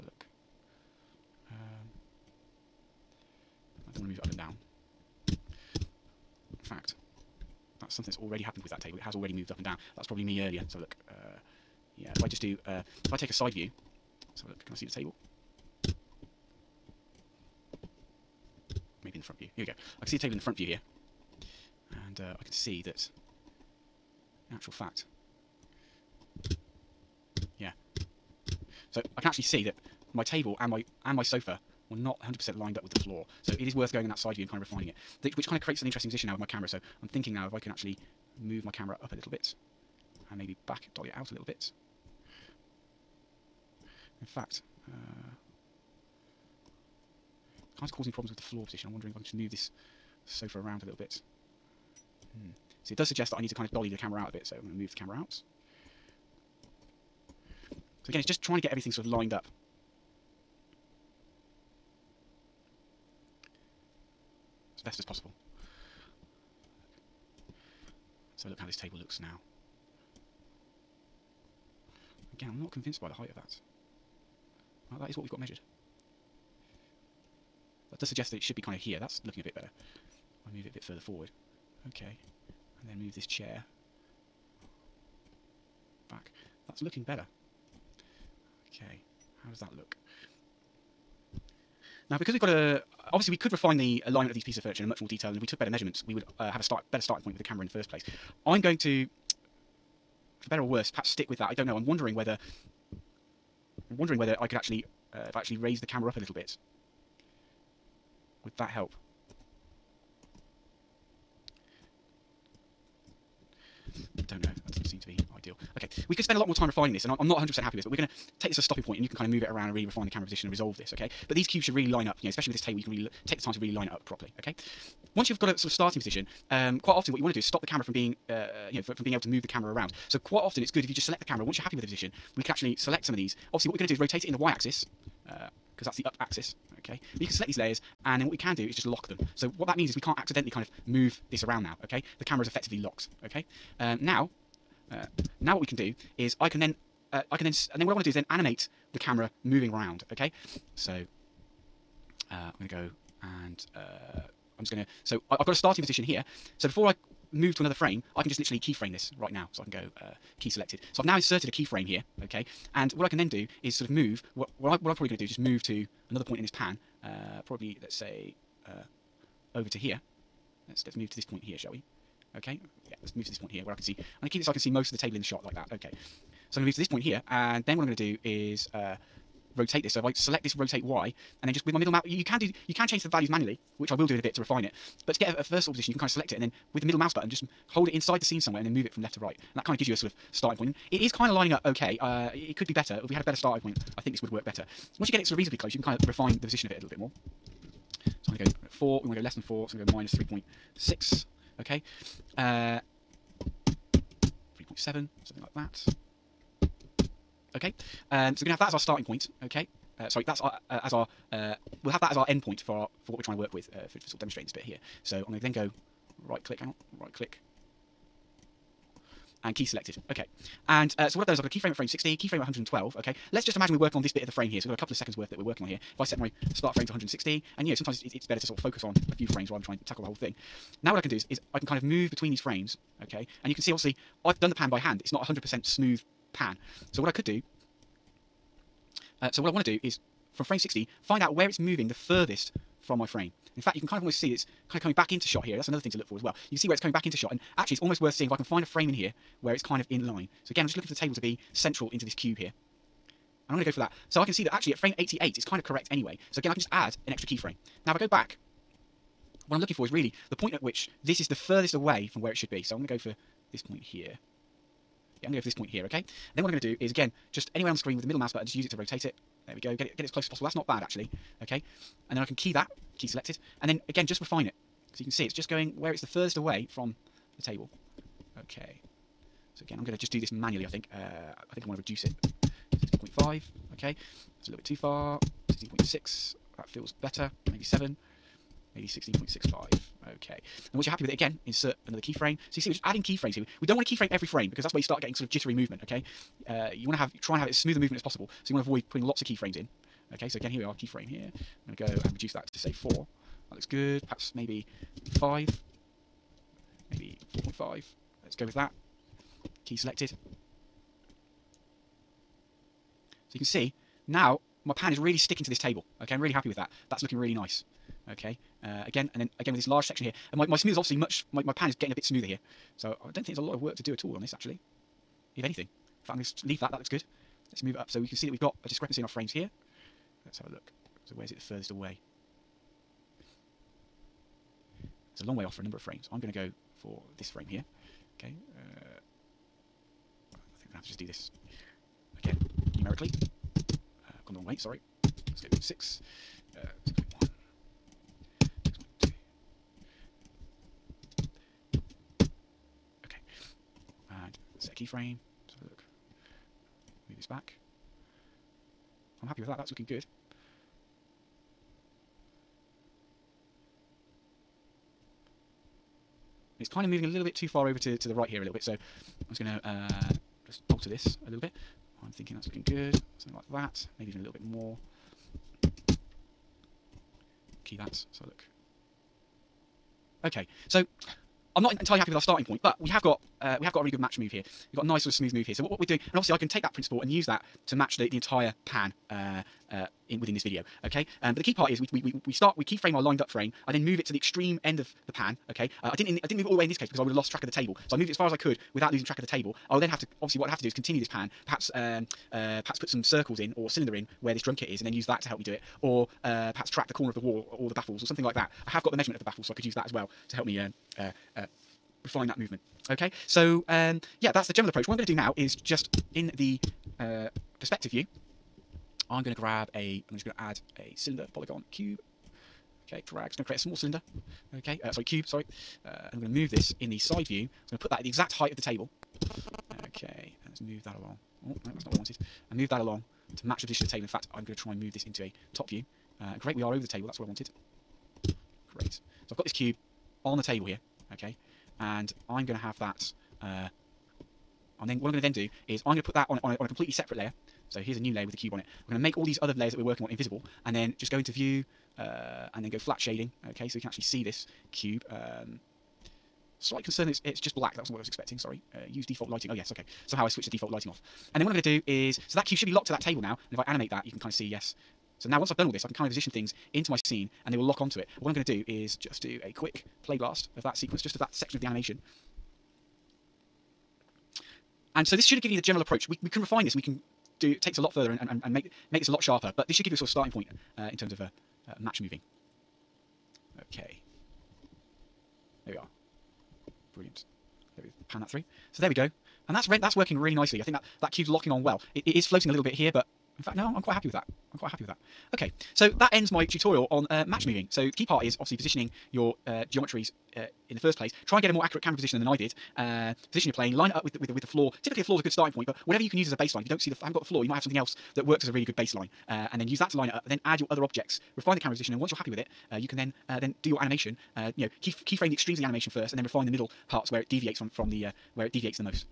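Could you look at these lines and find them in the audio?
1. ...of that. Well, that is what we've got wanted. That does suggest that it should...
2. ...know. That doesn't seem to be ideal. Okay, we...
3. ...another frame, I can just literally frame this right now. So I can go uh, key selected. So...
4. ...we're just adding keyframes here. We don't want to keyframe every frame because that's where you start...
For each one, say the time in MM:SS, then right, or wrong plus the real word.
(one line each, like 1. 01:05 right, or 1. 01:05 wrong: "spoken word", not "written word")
1. 01:13 wrong: "measured", not "wanted"
2. 01:54 right
3. 02:37 wrong: "keyframe", not "frame"
4. 04:52 right.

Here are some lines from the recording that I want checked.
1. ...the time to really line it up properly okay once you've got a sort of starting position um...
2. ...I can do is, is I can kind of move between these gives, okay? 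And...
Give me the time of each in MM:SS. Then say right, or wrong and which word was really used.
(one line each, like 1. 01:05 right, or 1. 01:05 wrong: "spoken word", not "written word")
1. 02:03 right
2. 03:50 wrong: "frames", not "gives".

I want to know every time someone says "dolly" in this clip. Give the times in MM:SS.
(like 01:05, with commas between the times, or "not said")
00:40, 00:53.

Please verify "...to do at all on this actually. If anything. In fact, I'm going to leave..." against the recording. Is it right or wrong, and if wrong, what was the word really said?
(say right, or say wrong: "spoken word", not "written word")
right.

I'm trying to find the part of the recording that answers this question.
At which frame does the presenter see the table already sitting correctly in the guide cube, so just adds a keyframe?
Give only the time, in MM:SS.
04:14.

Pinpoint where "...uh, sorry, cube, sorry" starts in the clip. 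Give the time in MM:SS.
07:04.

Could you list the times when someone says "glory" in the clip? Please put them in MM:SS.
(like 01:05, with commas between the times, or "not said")
not said.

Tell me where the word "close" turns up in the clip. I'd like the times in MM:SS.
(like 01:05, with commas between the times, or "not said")
03:15, 04:30.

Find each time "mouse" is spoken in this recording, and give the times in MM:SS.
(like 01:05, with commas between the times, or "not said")
03:06, 04:28.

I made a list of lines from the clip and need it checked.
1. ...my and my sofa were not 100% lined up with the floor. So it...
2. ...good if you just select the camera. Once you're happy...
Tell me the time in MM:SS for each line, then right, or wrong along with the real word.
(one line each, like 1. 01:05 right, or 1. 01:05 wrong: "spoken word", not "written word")
1. 00:30 right
2. 02:10 right.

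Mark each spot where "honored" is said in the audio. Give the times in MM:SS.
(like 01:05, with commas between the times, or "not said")
not said.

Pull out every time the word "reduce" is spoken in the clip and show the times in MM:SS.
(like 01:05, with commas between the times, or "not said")
04:41, 05:02.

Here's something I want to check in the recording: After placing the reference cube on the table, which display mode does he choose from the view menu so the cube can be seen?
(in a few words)
Flat shading.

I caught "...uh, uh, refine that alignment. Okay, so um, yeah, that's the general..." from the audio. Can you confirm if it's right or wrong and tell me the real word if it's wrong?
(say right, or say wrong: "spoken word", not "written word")
wrong: "movement", not "alignment".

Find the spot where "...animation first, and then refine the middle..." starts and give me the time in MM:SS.
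08:35.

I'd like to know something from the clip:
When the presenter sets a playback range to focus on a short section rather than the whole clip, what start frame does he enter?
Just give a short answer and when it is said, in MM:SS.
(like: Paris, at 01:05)
160, at 03:46.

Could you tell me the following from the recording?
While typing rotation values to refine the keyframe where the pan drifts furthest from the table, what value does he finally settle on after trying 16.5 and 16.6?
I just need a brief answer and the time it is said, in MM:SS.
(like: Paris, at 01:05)
16.65, at 04:48.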